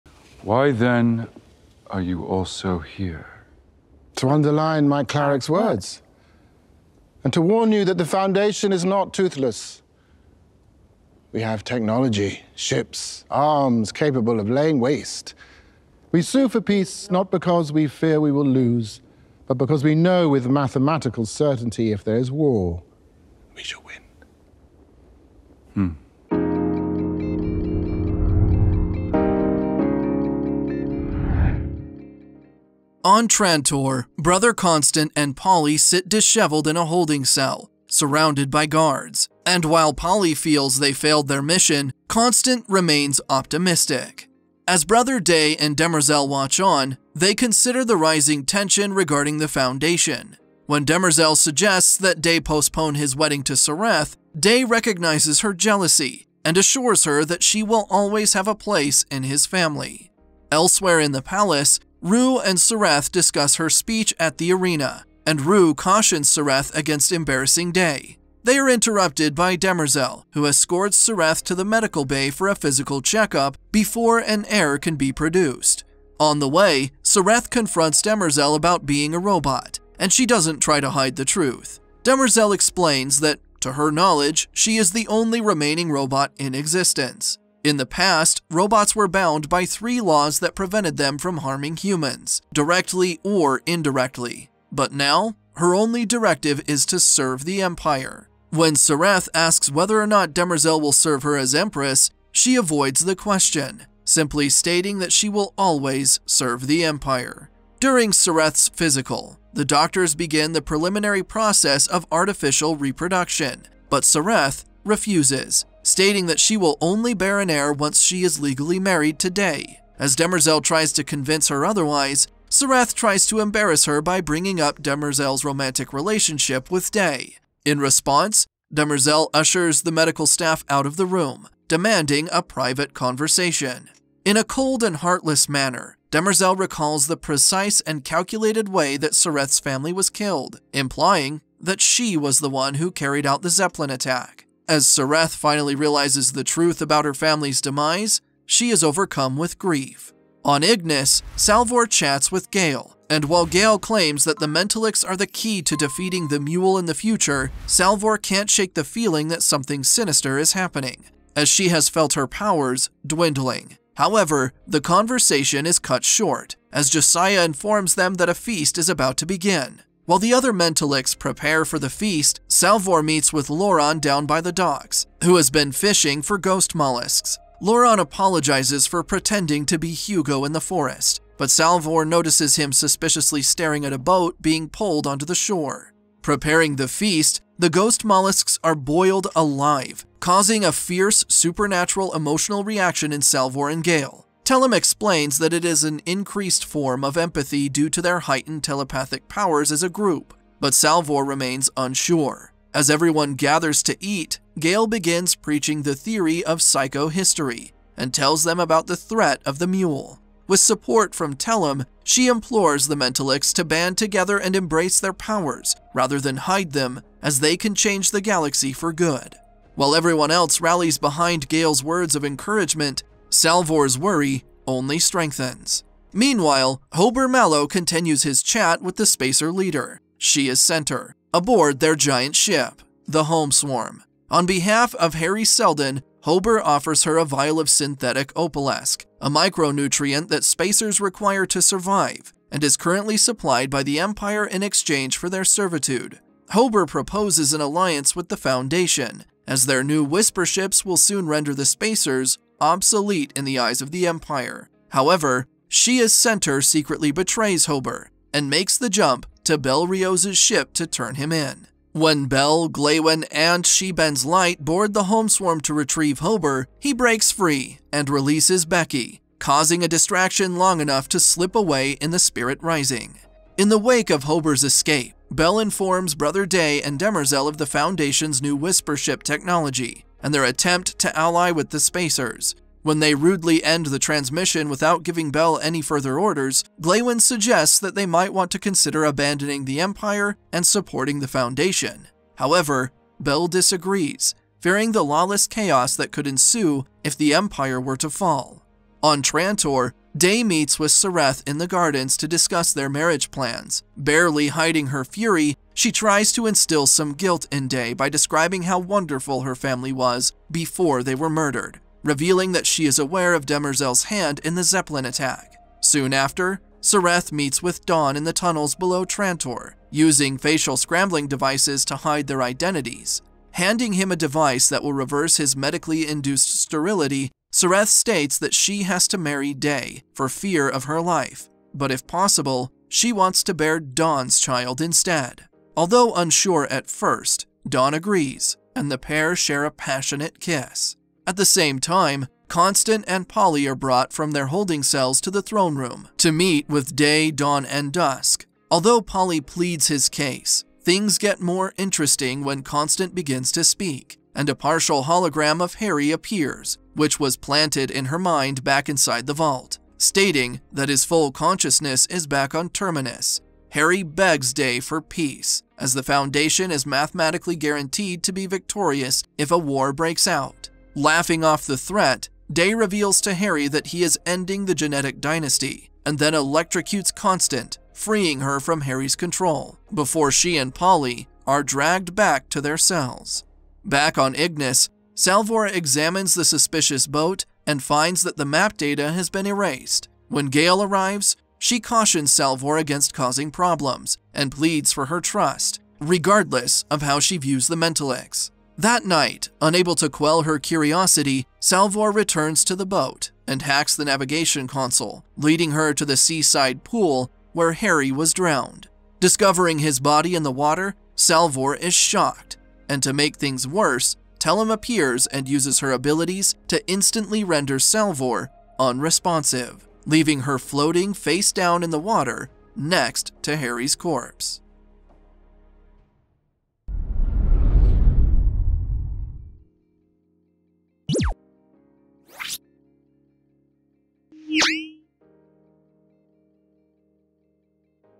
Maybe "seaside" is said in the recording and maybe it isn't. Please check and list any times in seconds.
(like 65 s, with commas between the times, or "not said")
406 s.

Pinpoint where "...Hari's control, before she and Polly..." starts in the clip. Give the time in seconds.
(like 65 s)
378 s.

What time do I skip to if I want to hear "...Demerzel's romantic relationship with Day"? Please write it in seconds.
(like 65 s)
124 s.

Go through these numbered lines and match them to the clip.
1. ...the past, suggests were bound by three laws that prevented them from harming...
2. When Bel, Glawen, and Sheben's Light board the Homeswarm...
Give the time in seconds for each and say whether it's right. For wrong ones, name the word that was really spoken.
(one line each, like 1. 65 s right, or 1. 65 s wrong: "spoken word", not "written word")
1. 87 s wrong: "robots", not "suggests"
2. 261 s right.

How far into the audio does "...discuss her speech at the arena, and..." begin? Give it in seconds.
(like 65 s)
63 s.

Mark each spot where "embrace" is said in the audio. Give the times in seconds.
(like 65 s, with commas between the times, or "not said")
214 s.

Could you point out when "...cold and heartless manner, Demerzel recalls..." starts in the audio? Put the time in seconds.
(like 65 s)
134 s.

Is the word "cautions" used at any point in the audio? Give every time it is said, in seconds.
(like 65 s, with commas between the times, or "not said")
65 s, 391 s.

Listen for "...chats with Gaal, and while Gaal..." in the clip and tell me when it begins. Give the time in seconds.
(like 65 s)
151 s.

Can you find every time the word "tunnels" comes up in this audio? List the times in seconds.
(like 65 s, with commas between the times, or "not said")
318 s.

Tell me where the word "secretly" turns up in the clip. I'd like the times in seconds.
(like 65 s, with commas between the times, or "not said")
256 s.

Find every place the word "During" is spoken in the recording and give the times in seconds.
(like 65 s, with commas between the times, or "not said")
107 s.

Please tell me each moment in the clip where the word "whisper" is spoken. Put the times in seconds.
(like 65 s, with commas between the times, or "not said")
250 s, 278 s.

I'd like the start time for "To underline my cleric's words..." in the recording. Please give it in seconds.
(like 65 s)
4 s.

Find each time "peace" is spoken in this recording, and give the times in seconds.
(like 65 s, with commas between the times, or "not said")
16 s, 365 s.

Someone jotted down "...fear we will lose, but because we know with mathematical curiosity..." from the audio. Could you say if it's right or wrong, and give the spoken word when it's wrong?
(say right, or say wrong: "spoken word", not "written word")
wrong: "certainty", not "curiosity".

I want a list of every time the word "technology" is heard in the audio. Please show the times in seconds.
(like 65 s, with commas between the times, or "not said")
11 s, 279 s.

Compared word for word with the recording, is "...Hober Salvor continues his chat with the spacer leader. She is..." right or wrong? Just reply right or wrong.
wrong.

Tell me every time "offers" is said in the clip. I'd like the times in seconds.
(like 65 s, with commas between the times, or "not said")
236 s.